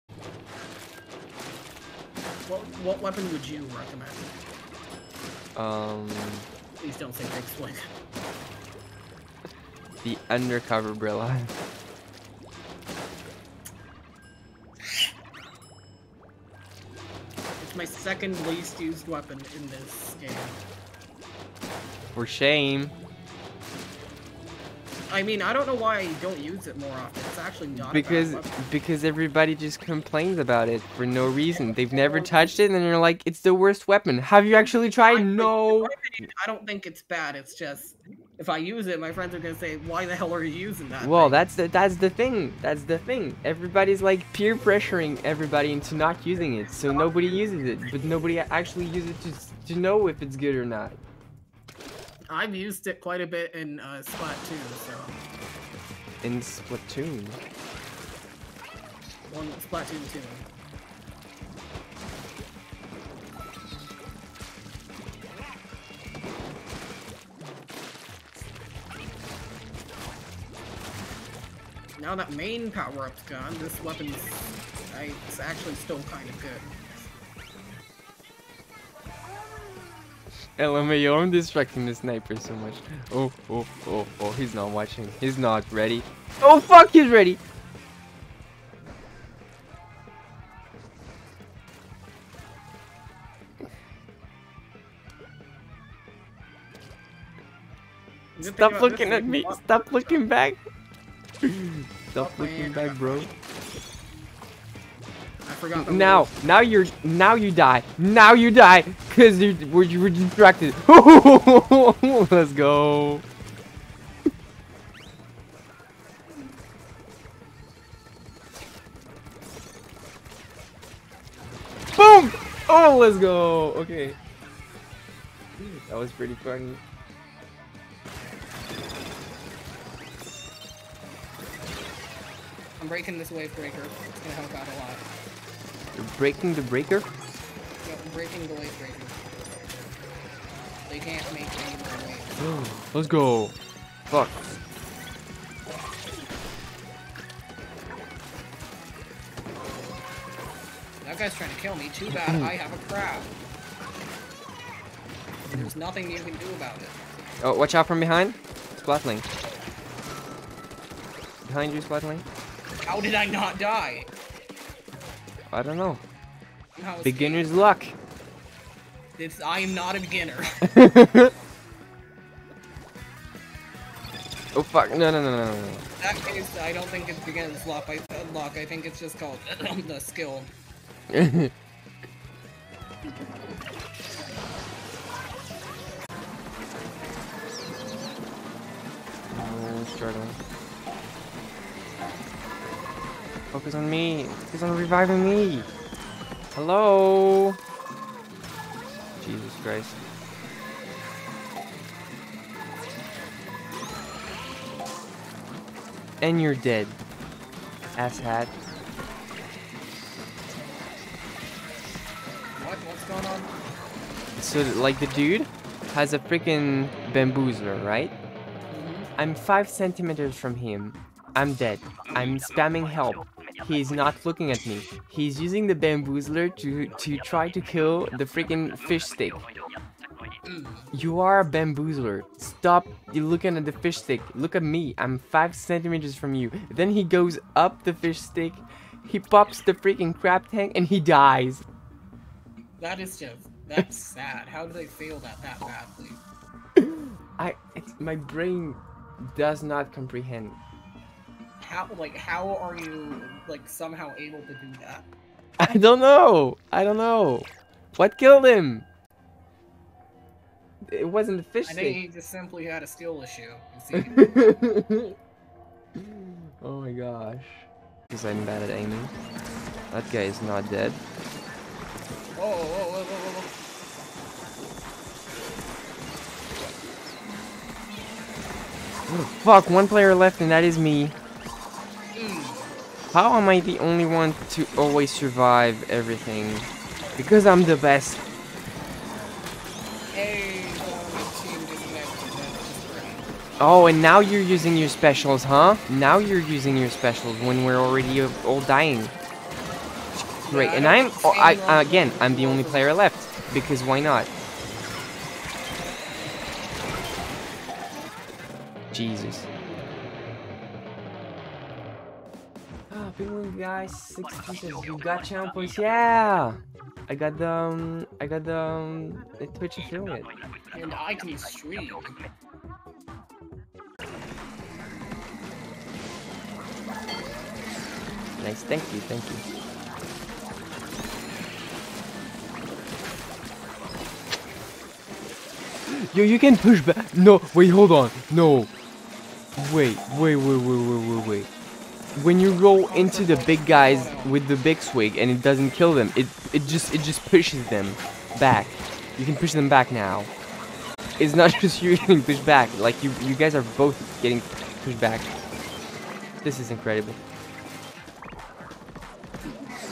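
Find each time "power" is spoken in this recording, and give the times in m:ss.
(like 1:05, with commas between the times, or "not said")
1:12.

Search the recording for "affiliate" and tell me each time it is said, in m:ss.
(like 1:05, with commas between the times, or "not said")
5:19.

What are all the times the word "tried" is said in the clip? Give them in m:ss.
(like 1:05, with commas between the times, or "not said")
0:34.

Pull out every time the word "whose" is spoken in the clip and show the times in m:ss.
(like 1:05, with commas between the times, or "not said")
not said.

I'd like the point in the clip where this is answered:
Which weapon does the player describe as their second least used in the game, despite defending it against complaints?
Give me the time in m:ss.
0:10.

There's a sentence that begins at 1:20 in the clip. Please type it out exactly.
LMAO, I'm distracting the sniper so much.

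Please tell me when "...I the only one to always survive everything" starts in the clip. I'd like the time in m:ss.
4:43.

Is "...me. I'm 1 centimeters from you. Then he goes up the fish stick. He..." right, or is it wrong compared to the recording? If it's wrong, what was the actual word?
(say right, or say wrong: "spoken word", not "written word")
wrong: "5", not "1".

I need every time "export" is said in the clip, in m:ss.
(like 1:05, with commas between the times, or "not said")
not said.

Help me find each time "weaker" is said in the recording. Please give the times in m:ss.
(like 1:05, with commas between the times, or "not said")
not said.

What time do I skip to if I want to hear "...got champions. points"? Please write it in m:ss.
5:14.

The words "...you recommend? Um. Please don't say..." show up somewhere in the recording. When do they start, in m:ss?
0:03.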